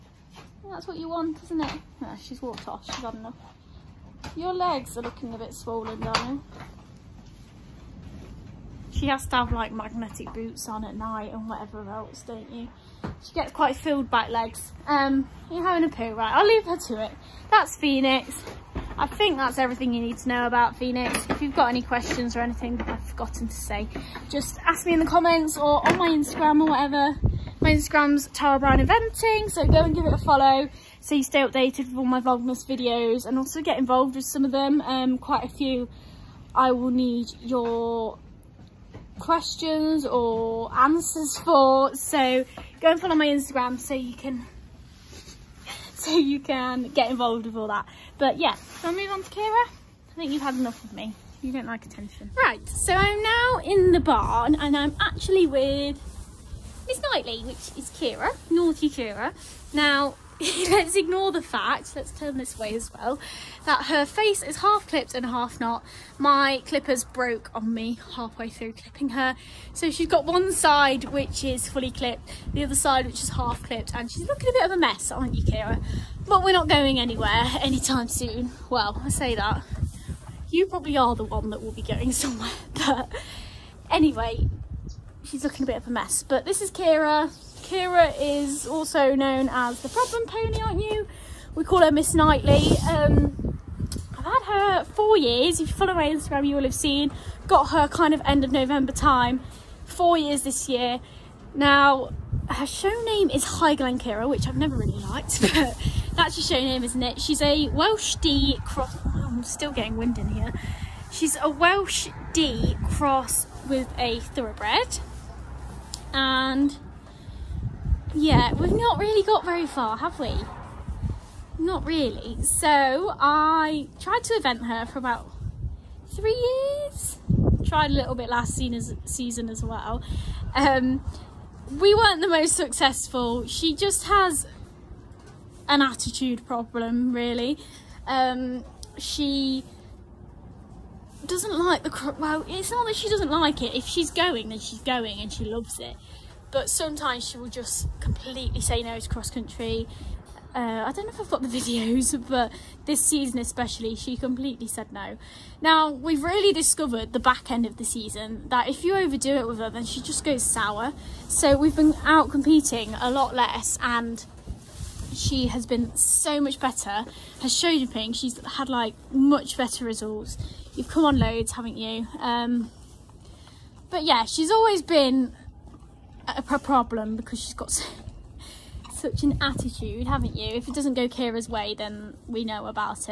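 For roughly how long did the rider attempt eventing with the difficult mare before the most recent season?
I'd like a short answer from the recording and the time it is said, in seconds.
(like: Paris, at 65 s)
3 years, at 124 s.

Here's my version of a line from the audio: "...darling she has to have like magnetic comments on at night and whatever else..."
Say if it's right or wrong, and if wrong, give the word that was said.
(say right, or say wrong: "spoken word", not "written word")
wrong: "boots", not "comments".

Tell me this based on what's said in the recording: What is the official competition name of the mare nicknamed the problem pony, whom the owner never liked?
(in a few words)
High Kira.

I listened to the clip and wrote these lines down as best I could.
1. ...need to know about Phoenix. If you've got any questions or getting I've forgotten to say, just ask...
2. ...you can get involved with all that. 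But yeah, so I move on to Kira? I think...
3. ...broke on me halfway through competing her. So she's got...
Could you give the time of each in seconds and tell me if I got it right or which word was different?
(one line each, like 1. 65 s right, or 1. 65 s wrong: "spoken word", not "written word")
1. 20 s wrong: "anything", not "getting"
2. 46 s right
3. 67 s wrong: "clipping", not "competing".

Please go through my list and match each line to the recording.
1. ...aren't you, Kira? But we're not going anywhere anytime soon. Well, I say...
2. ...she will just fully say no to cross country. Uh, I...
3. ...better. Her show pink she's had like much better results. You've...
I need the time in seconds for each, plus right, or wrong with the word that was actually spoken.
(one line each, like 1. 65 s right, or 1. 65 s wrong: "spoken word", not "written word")
1. 75 s right
2. 147 s wrong: "completely", not "fully"
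3. 166 s right.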